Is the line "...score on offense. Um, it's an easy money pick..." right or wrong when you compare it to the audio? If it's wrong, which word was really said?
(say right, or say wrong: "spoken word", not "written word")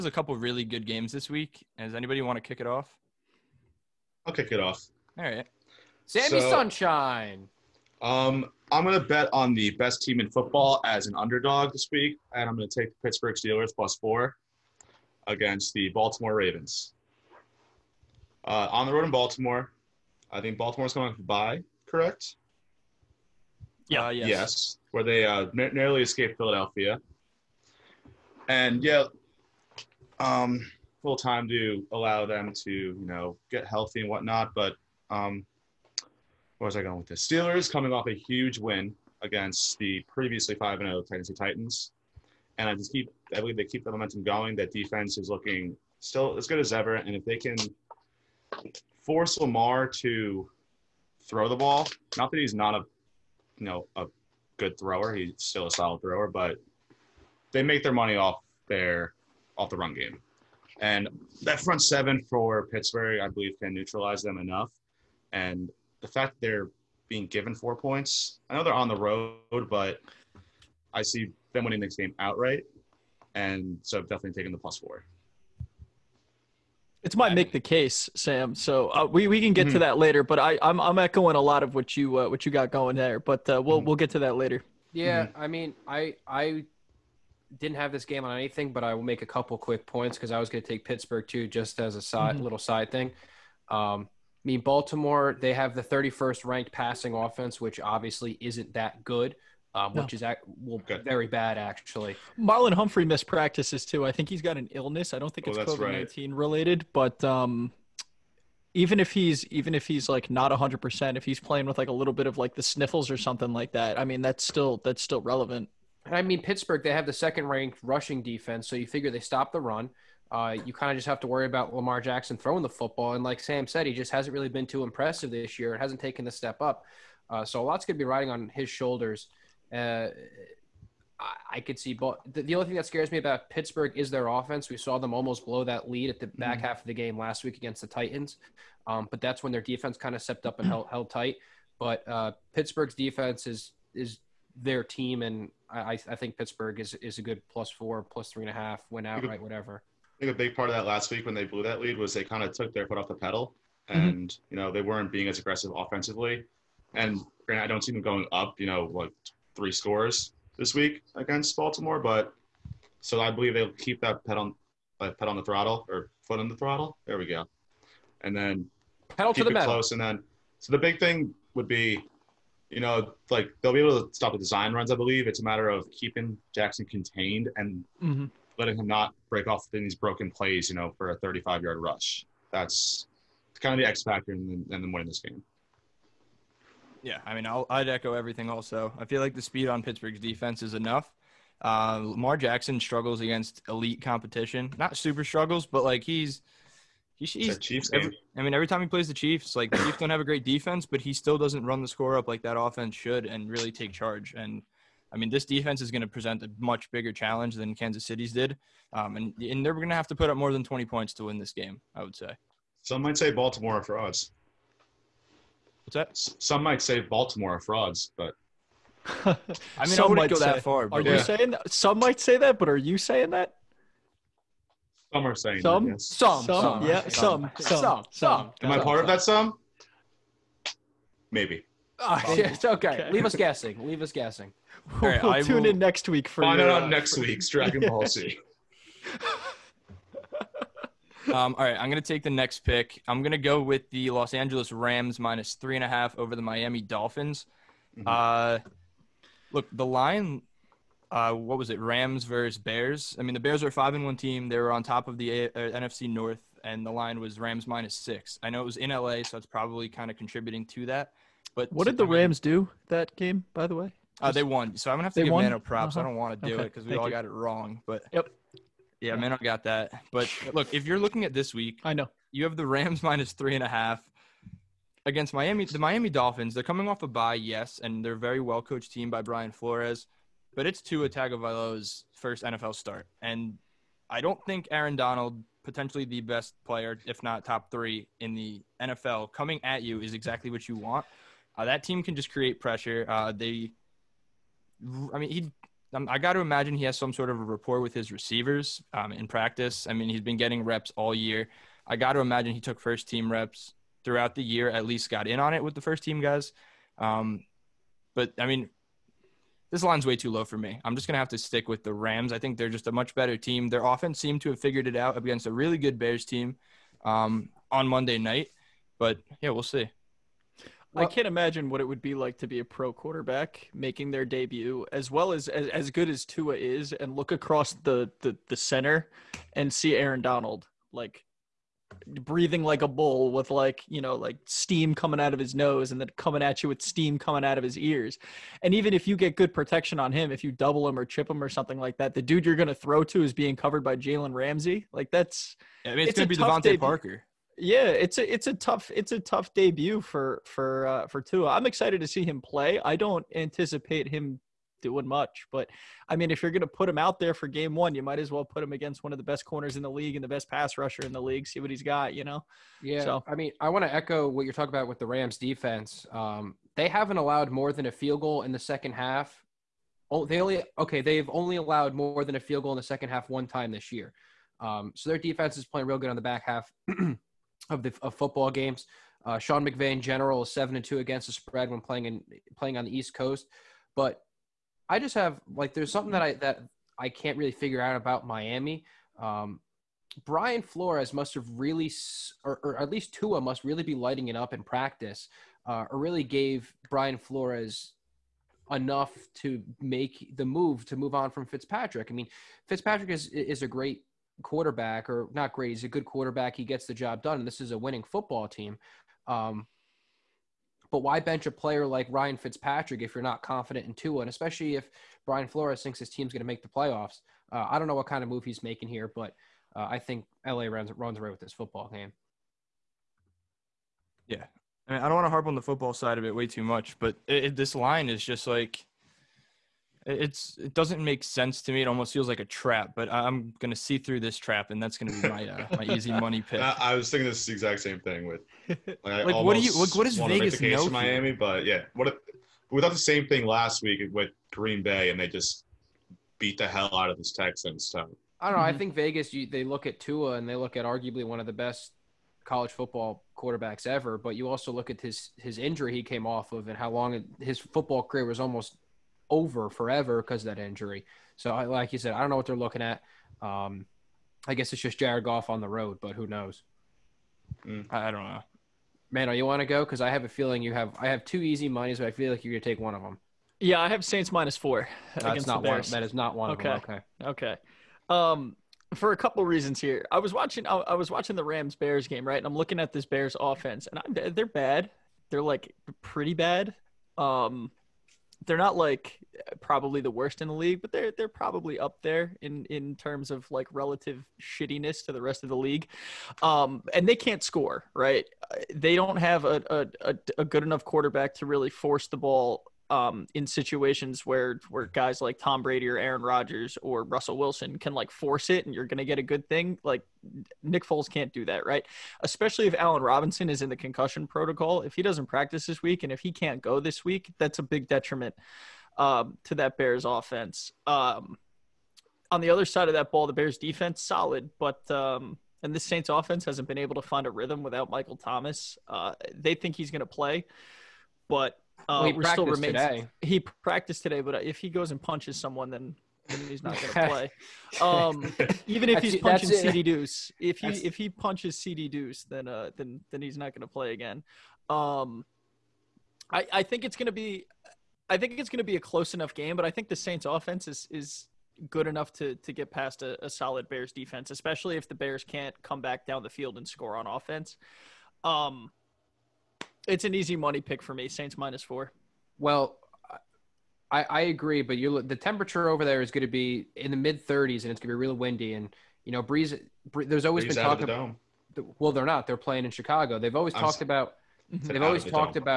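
right.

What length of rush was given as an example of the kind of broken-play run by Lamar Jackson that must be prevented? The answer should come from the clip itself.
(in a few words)
35 yards.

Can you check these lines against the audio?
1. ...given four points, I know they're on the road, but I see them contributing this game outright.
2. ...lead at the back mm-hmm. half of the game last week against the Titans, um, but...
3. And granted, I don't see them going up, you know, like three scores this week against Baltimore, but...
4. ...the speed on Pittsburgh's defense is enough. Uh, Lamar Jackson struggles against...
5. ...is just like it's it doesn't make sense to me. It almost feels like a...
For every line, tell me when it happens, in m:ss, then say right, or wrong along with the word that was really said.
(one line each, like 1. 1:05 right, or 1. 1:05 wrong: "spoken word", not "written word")
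1. 1:07 wrong: "winning", not "contributing"
2. 2:15 right
3. 2:36 right
4. 3:09 right
5. 7:08 right.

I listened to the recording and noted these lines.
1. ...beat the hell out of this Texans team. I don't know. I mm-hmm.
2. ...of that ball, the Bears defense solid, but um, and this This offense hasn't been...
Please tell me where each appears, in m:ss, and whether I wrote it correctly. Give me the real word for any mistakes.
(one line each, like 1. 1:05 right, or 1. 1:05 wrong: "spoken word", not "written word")
1. 7:26 right
2. 8:42 wrong: "Saints", not "This".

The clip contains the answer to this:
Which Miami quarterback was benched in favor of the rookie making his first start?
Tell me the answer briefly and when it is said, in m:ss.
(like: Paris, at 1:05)
Ryan Fitzpatrick, at 6:52.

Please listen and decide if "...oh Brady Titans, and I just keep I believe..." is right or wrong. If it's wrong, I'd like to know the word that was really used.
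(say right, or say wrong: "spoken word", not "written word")
wrong: "Tennessee", not "Brady".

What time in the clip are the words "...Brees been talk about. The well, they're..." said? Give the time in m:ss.
9:30.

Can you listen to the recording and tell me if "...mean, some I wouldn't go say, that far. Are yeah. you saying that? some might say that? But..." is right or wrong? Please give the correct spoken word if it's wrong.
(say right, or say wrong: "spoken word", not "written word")
right.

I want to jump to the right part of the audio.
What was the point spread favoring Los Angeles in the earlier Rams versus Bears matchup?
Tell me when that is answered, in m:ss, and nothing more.
4:17.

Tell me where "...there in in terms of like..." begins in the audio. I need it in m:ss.
8:12.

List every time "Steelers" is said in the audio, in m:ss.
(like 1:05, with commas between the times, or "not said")
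0:13, 0:37.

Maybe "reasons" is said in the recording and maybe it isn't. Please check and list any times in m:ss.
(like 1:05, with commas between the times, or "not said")
7:59.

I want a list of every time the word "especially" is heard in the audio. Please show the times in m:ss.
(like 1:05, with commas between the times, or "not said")
6:54, 8:32, 9:14.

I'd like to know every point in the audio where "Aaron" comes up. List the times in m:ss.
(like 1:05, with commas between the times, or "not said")
4:44, 5:29, 8:25.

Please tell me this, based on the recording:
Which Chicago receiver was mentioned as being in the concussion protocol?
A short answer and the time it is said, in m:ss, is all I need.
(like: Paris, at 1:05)
Allen Robinson, at 8:32.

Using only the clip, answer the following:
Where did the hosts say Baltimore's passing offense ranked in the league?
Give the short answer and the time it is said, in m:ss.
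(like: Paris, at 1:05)
31st, at 1:35.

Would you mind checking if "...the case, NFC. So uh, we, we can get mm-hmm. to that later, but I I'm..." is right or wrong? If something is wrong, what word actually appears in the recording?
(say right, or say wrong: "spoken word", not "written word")
wrong: "Sam", not "NFC".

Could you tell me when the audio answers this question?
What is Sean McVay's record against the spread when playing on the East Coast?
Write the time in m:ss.
6:20.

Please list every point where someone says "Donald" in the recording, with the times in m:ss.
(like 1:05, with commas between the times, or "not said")
4:44, 5:30.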